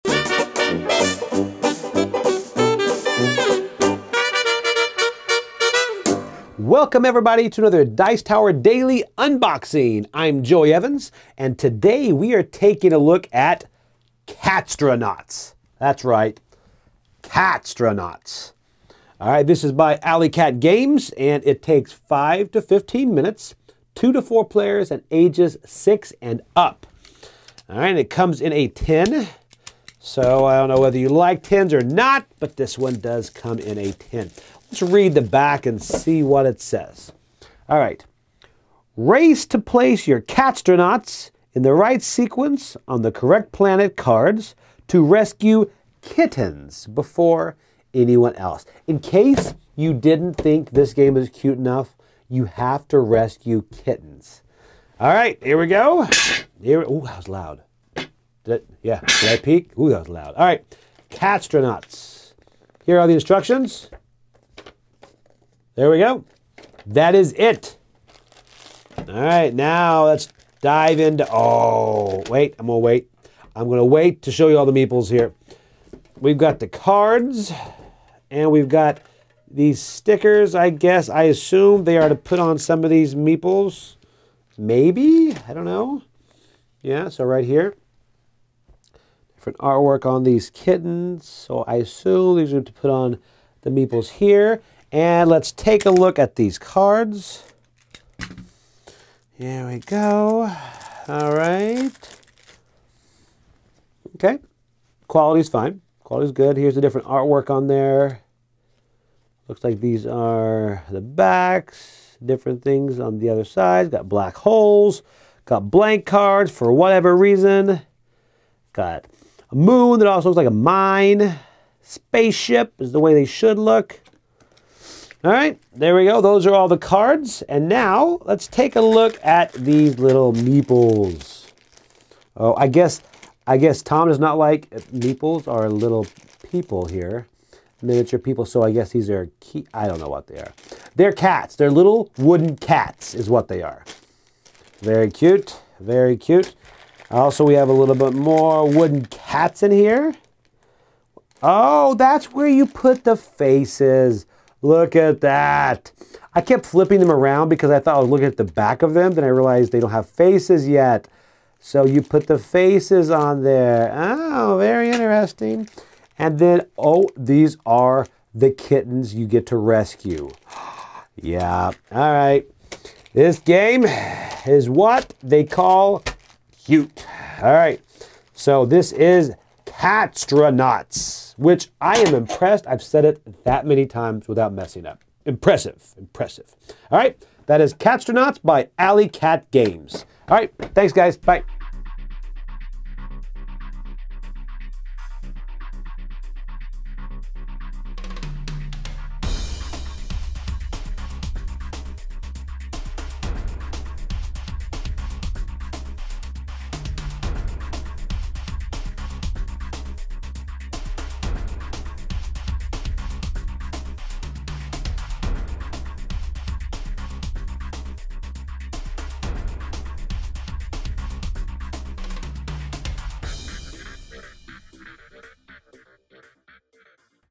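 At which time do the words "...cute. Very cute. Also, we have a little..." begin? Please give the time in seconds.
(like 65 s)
145 s.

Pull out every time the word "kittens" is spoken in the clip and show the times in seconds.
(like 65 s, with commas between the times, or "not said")
46 s, 53 s, 90 s, 168 s.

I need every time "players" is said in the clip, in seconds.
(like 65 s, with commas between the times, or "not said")
24 s.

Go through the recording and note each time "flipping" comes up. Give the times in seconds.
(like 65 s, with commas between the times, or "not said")
156 s.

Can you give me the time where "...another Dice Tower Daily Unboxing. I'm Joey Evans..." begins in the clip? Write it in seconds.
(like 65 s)
7 s.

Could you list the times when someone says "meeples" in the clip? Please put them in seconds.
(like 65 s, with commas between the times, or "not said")
74 s, 83 s, 93 s, 130 s, 134 s.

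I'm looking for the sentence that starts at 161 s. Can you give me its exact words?
So you put the faces on there.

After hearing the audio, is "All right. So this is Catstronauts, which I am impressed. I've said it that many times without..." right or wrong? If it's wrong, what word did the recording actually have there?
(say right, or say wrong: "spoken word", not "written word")
right.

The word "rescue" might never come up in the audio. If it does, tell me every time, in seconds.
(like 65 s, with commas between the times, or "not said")
45 s, 52 s, 169 s.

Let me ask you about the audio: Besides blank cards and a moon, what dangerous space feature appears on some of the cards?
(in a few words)
Black holes.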